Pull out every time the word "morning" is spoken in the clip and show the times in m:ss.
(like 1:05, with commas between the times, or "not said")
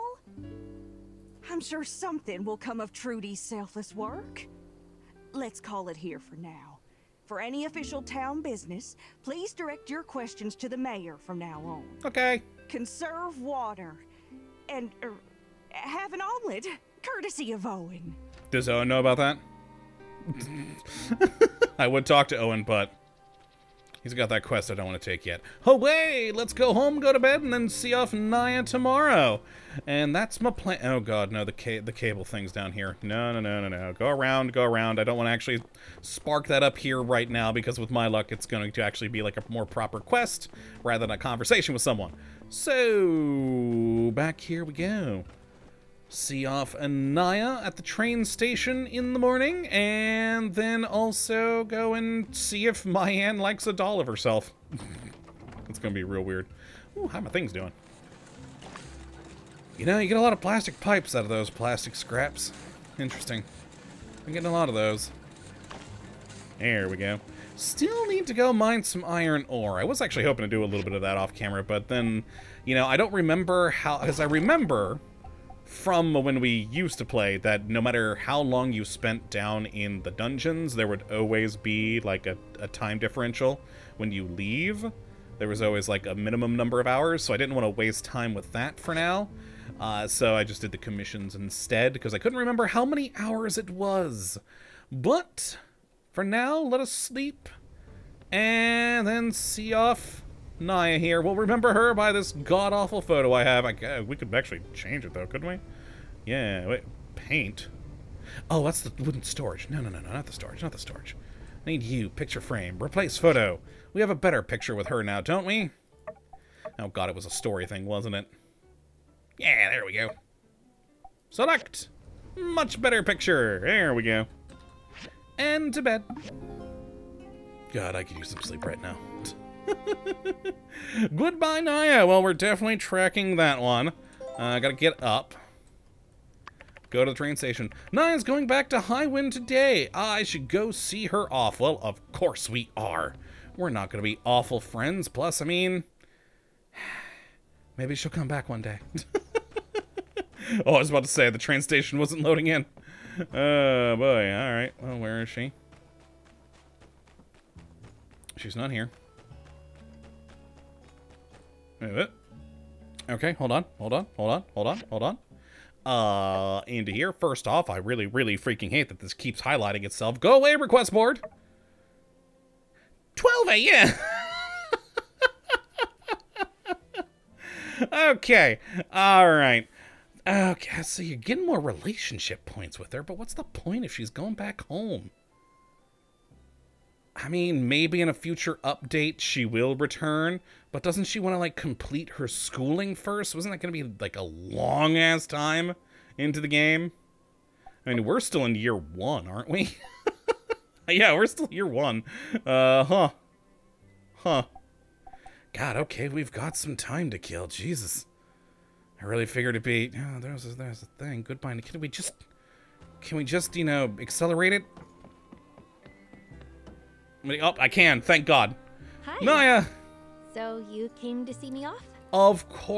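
0:49.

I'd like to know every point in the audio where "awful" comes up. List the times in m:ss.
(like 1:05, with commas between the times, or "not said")
1:42, 2:24.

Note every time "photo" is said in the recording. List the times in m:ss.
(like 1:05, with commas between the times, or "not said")
1:43, 1:53.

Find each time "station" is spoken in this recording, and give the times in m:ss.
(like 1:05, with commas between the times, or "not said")
0:48, 2:17, 2:31.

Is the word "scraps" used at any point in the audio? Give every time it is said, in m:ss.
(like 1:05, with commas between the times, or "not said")
1:01.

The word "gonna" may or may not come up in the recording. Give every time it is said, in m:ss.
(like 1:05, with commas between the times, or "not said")
0:55, 2:23.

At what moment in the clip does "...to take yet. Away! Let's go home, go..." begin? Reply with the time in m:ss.
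0:25.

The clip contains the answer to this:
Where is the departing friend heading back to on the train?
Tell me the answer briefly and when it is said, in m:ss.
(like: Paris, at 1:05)
Highwind, at 2:18.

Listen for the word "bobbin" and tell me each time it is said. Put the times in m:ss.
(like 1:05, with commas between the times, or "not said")
not said.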